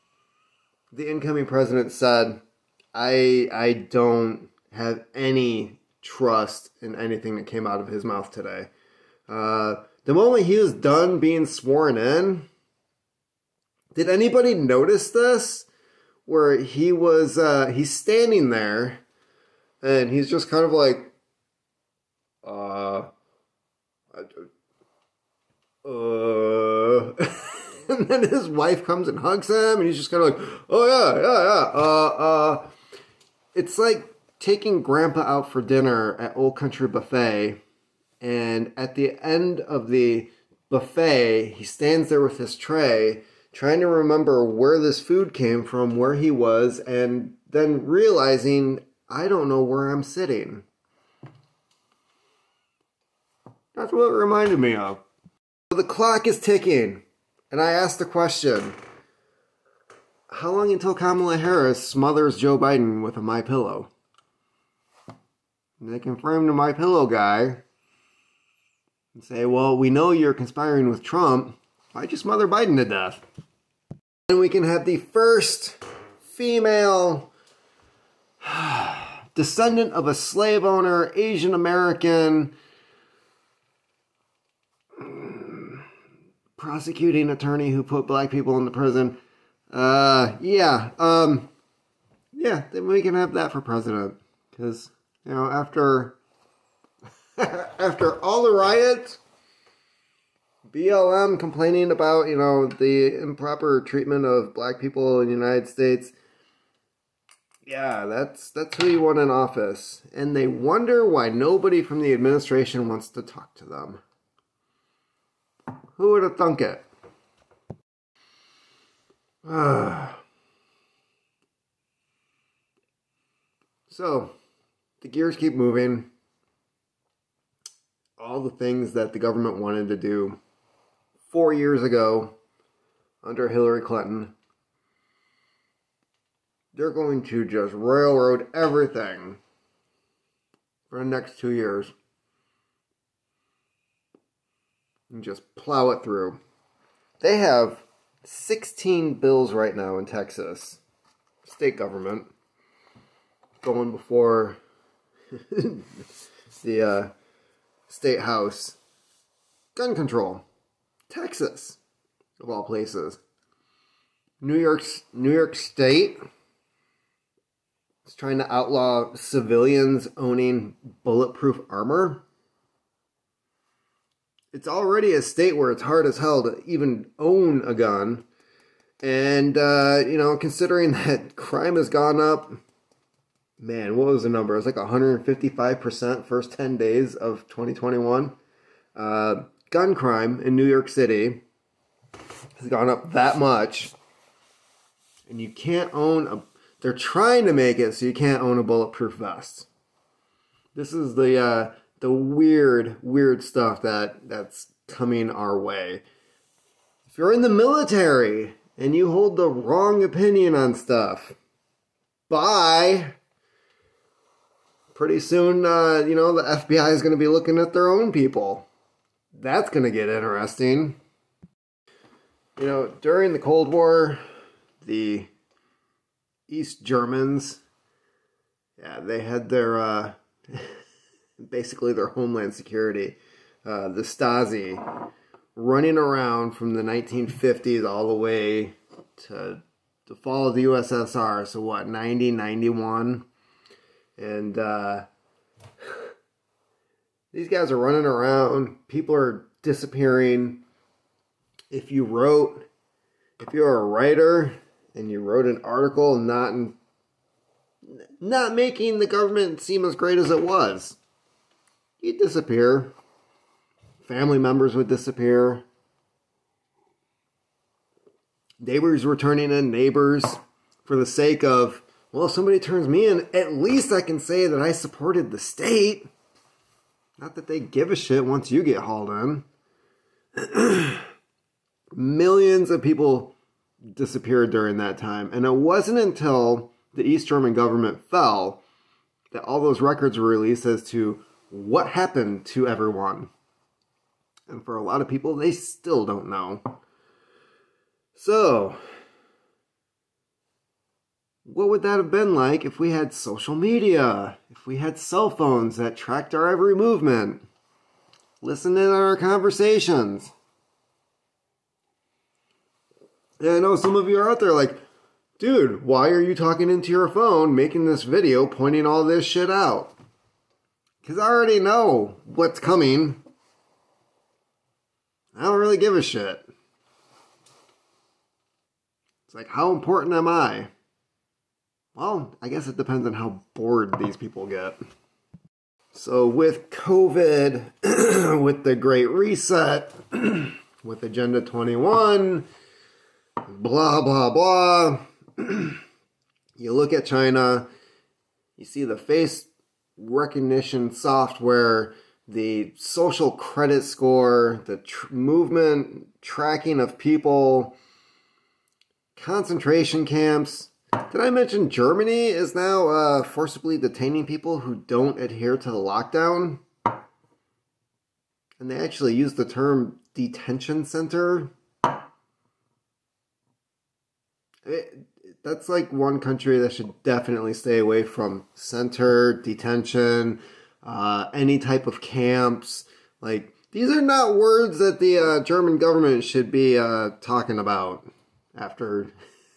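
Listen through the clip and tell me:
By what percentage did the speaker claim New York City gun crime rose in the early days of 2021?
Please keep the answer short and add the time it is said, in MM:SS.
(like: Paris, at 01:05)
155%, at 03:04.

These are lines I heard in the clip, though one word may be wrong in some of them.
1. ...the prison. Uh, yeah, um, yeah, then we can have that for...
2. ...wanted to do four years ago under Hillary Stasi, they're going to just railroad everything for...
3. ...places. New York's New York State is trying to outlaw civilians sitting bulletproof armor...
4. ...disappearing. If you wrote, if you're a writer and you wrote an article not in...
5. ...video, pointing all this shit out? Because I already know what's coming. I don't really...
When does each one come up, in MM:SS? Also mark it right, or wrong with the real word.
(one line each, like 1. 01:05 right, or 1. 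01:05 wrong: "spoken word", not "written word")
1. 01:28 right
2. 02:09 wrong: "Clinton", not "Stasi"
3. 02:42 wrong: "owning", not "sitting"
4. 04:09 right
5. 05:18 right.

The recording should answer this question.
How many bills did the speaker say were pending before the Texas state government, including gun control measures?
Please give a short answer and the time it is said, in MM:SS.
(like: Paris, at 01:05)
16, at 02:28.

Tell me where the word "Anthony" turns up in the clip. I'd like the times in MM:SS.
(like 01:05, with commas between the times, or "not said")
not said.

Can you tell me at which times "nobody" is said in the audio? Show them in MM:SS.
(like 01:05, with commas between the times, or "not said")
01:51.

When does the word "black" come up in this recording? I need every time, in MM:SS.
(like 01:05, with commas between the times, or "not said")
01:28, 01:44.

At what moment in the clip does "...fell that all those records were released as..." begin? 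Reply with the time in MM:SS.
04:48.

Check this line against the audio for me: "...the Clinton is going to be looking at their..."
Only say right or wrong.
wrong.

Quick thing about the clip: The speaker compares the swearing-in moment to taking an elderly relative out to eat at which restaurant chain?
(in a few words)
Old Country Buffet.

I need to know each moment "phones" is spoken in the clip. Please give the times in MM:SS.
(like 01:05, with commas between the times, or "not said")
05:05, 05:17.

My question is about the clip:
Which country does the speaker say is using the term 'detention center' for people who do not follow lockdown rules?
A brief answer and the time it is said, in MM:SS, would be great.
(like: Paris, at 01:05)
Germany, at 06:01.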